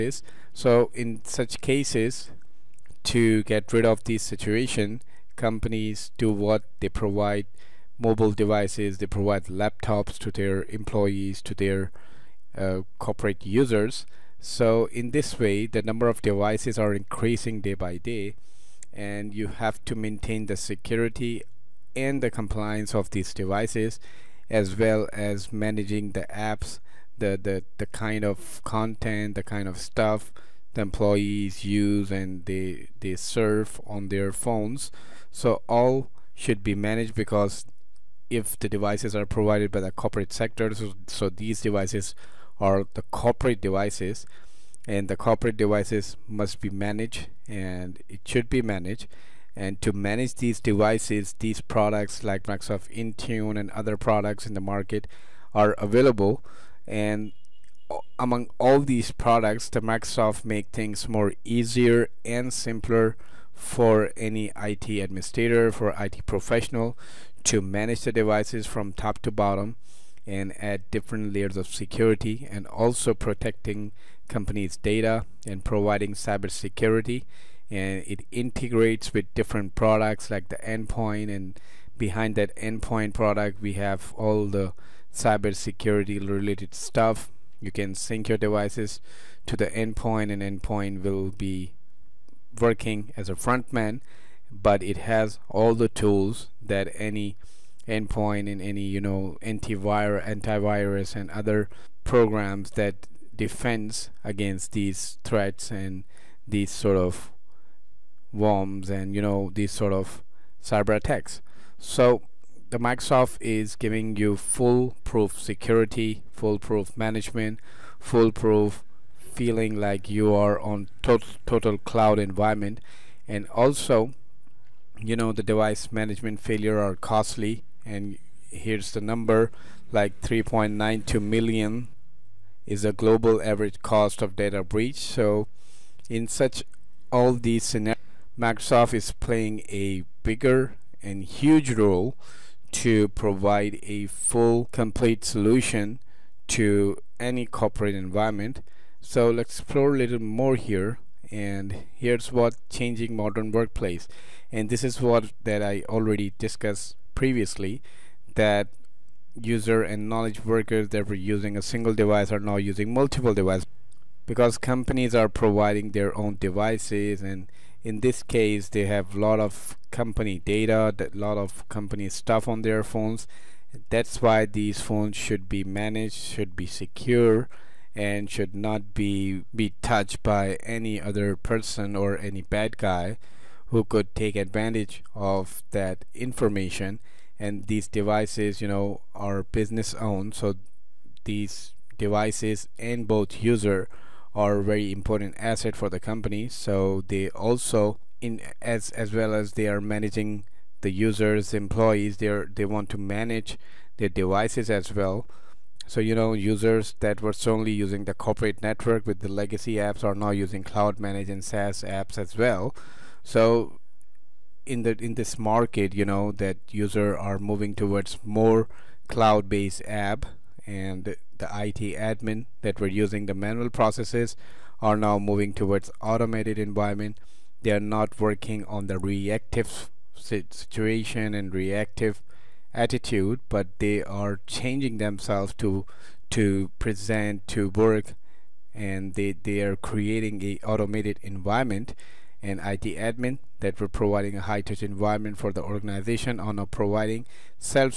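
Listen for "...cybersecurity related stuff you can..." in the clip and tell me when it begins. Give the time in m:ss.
1:25.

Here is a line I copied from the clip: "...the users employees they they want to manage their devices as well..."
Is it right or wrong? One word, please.
right.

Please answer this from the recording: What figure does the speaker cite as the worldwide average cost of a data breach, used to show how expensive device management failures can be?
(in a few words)
3.92 million.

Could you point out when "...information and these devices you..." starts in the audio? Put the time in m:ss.
3:06.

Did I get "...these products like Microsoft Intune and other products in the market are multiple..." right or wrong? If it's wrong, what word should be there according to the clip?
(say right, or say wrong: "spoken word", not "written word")
wrong: "available", not "multiple".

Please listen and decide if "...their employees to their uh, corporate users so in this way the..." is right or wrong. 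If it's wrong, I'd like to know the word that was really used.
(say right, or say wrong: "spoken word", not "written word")
right.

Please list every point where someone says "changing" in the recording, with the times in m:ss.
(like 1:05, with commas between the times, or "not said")
2:32, 3:54.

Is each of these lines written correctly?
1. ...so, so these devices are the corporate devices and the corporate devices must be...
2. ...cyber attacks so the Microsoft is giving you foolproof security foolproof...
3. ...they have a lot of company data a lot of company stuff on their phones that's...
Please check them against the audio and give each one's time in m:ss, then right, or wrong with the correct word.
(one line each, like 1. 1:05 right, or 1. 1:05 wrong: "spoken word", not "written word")
1. 0:40 right
2. 1:50 right
3. 2:48 right.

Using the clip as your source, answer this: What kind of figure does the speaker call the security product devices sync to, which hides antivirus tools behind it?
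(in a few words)
frontman.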